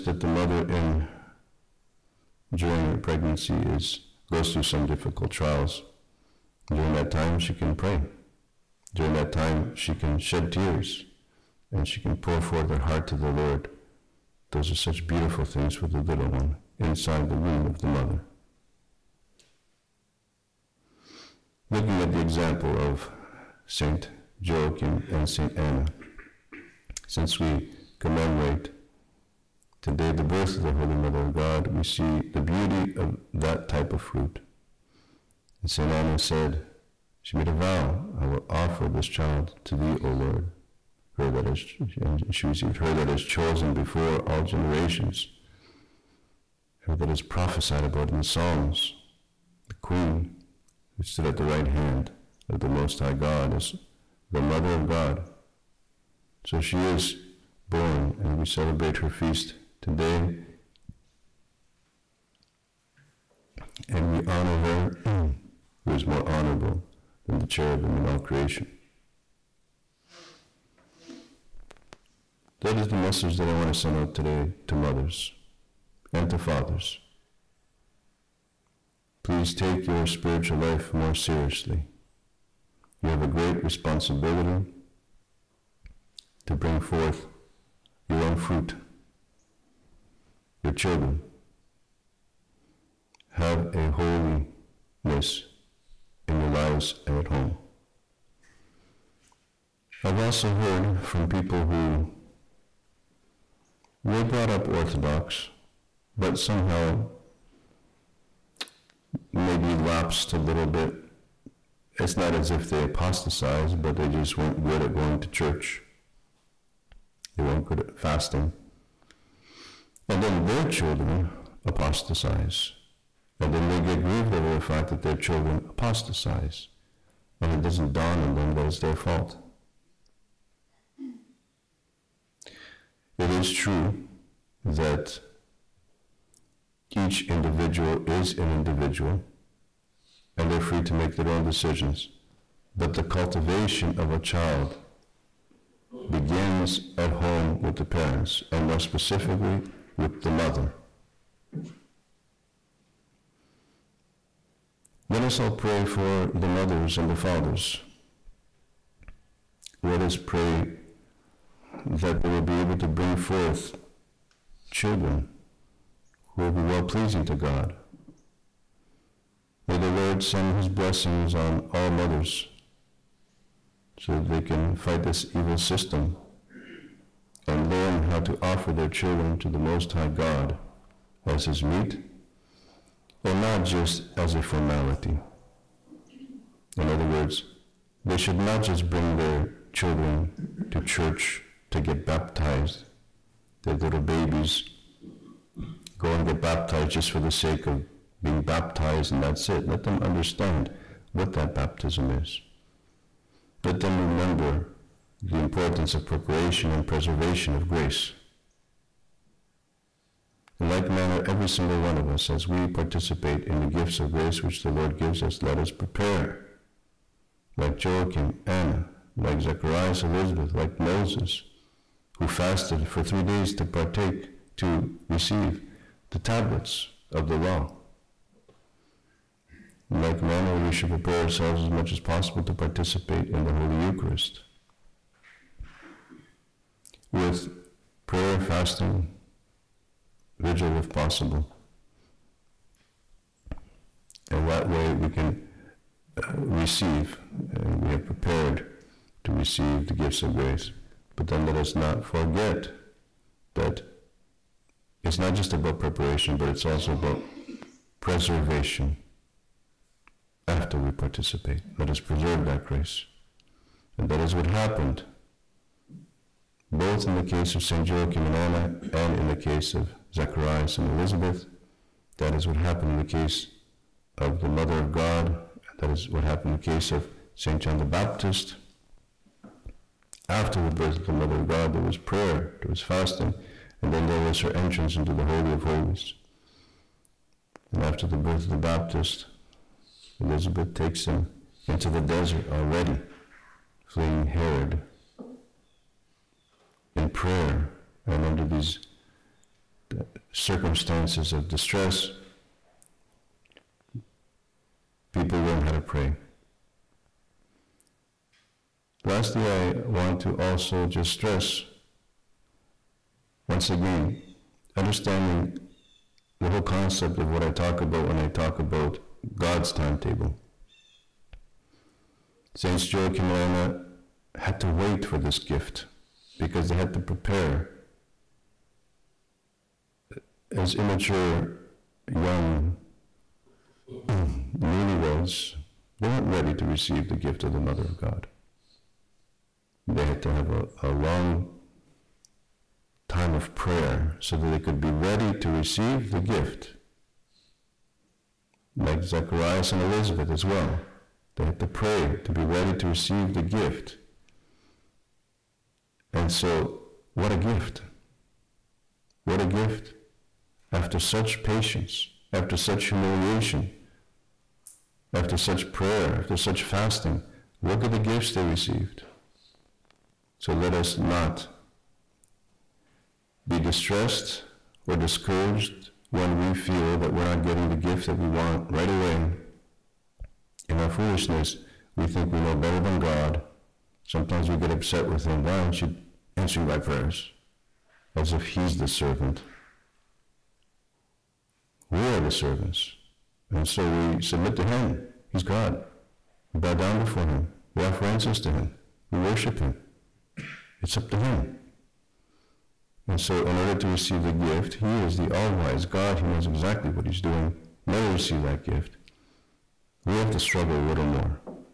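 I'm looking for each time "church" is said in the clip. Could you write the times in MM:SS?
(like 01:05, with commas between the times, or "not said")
01:55, 03:10.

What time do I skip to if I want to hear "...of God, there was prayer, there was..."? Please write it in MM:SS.
04:41.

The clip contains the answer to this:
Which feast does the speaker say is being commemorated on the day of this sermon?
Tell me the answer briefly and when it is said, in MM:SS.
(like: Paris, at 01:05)
The birth of the Holy Mother of God, at 00:30.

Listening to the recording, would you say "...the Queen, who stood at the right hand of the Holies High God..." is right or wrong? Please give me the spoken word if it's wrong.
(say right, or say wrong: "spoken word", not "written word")
wrong: "Most", not "Holies".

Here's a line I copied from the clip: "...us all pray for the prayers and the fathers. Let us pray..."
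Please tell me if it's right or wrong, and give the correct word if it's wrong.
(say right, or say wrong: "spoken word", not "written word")
wrong: "mothers", not "prayers".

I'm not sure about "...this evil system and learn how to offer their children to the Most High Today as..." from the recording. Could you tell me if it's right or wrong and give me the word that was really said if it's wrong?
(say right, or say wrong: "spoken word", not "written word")
wrong: "God", not "Today".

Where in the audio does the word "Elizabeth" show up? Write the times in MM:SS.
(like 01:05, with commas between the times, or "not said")
03:40, 04:30, 04:50, 05:49.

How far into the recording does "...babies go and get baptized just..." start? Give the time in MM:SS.
03:14.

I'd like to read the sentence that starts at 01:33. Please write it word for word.
Have a holiness in your lives and at home.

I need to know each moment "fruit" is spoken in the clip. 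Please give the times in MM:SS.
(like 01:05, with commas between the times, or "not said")
00:34, 01:28.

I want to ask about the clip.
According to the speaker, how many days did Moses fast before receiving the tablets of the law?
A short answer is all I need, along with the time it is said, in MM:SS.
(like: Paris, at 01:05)
3, at 03:43.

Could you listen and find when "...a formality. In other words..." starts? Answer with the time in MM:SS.
03:04.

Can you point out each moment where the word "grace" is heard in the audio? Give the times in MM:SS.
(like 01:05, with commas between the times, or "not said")
03:27, 03:34, 04:10, 04:22.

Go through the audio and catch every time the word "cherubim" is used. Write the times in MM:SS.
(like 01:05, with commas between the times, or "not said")
01:07.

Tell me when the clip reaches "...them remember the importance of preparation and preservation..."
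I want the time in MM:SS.
03:23.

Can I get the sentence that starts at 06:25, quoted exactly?
Why aren't you answering my prayers?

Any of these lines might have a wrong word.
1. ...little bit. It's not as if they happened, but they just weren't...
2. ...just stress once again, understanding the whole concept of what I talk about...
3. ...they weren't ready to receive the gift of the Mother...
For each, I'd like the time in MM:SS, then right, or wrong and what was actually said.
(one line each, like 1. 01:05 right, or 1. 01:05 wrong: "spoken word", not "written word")
1. 01:50 wrong: "apostatized", not "happened"
2. 05:10 right
3. 05:36 right.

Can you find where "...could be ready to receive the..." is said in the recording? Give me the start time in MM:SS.
05:44.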